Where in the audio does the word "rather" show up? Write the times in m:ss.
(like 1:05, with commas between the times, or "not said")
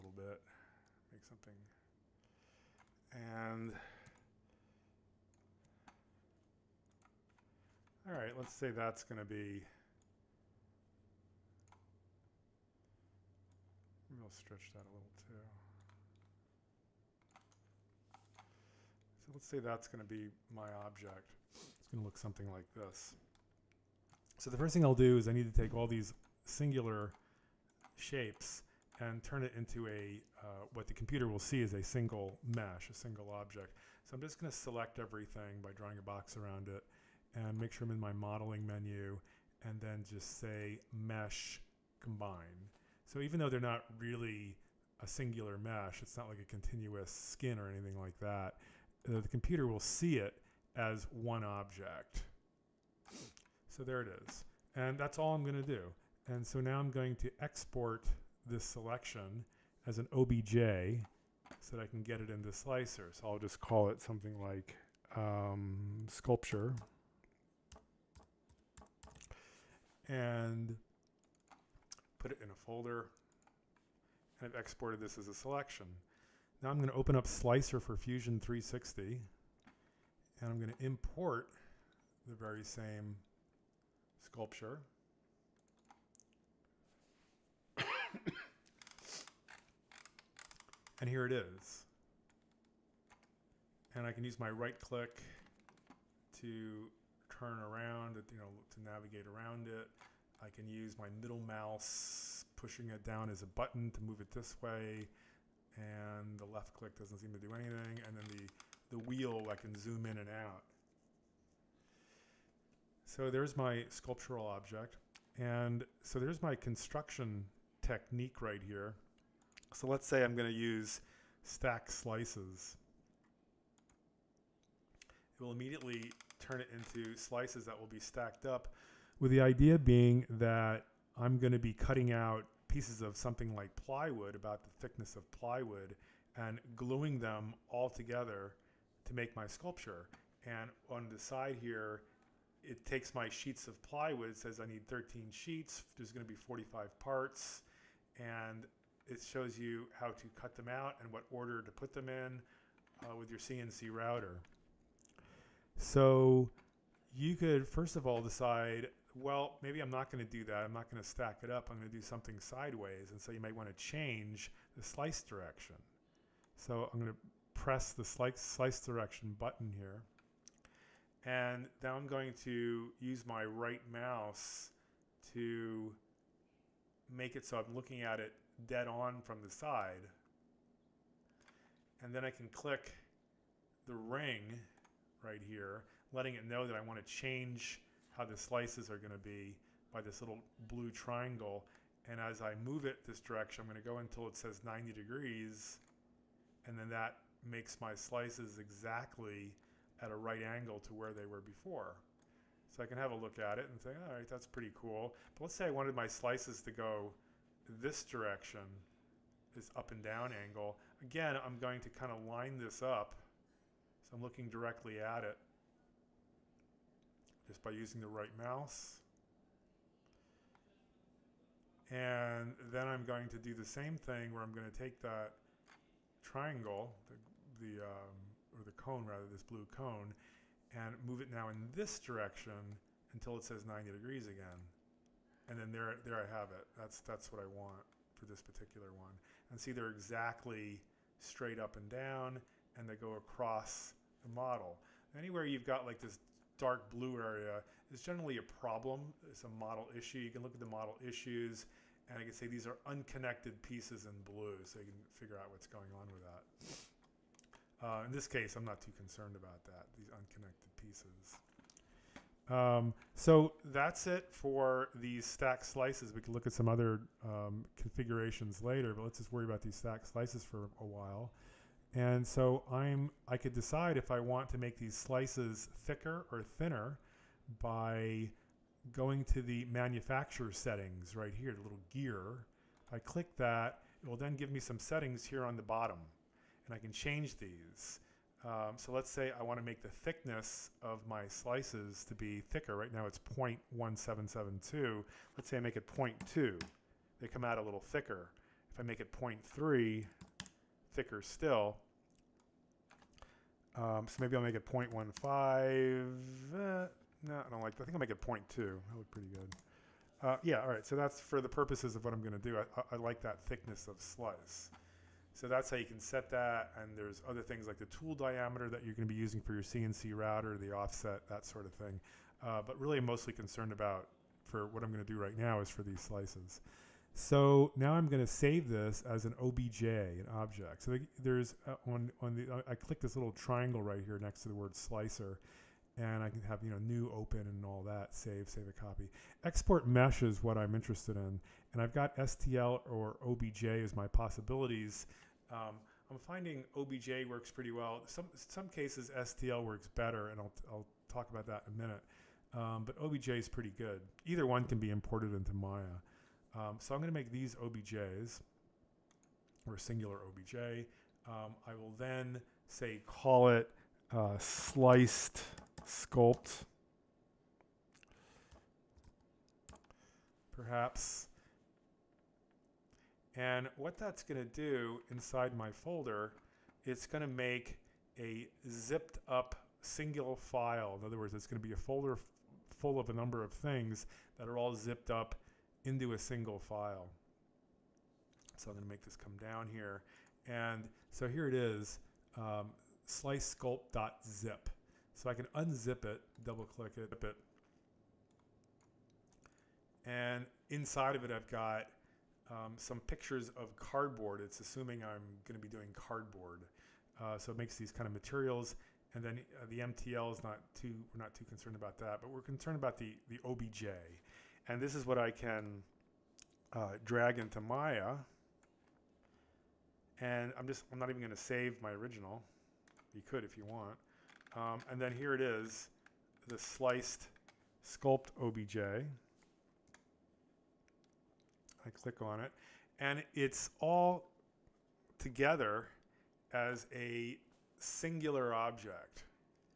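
3:49.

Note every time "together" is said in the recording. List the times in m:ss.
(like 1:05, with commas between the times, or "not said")
2:17, 7:15.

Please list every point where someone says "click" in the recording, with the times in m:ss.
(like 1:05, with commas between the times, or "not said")
1:34, 1:46, 3:02, 4:42, 5:32, 6:36, 7:12.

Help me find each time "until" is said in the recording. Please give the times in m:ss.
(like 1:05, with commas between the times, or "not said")
3:13, 3:53.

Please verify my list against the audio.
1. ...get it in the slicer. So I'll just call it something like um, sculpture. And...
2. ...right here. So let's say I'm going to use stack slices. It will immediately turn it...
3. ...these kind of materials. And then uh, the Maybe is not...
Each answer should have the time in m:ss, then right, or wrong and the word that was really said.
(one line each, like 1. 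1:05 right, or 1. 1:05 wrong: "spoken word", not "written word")
1. 1:02 right
2. 1:58 right
3. 6:47 wrong: "MTL", not "Maybe".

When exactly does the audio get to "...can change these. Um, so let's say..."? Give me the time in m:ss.
4:46.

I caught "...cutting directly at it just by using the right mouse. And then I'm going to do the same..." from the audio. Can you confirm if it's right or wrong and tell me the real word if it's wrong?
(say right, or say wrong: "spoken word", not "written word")
wrong: "looking", not "cutting".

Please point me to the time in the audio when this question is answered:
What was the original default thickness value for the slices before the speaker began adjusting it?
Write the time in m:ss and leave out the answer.
4:53.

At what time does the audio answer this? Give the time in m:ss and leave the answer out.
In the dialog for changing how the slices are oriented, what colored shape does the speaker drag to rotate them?
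3:49.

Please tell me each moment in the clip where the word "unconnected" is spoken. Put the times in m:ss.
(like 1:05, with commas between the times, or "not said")
4:12, 4:20.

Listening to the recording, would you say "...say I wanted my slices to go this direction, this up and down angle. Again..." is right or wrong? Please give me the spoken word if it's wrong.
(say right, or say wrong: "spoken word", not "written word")
right.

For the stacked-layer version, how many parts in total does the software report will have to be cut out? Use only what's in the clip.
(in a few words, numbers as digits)
45.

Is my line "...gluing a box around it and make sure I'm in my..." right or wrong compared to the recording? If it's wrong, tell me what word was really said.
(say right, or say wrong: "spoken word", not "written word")
wrong: "drawing", not "gluing".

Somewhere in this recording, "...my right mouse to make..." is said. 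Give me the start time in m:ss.
2:53.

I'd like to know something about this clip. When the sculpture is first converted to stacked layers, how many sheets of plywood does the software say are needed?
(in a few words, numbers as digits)
13.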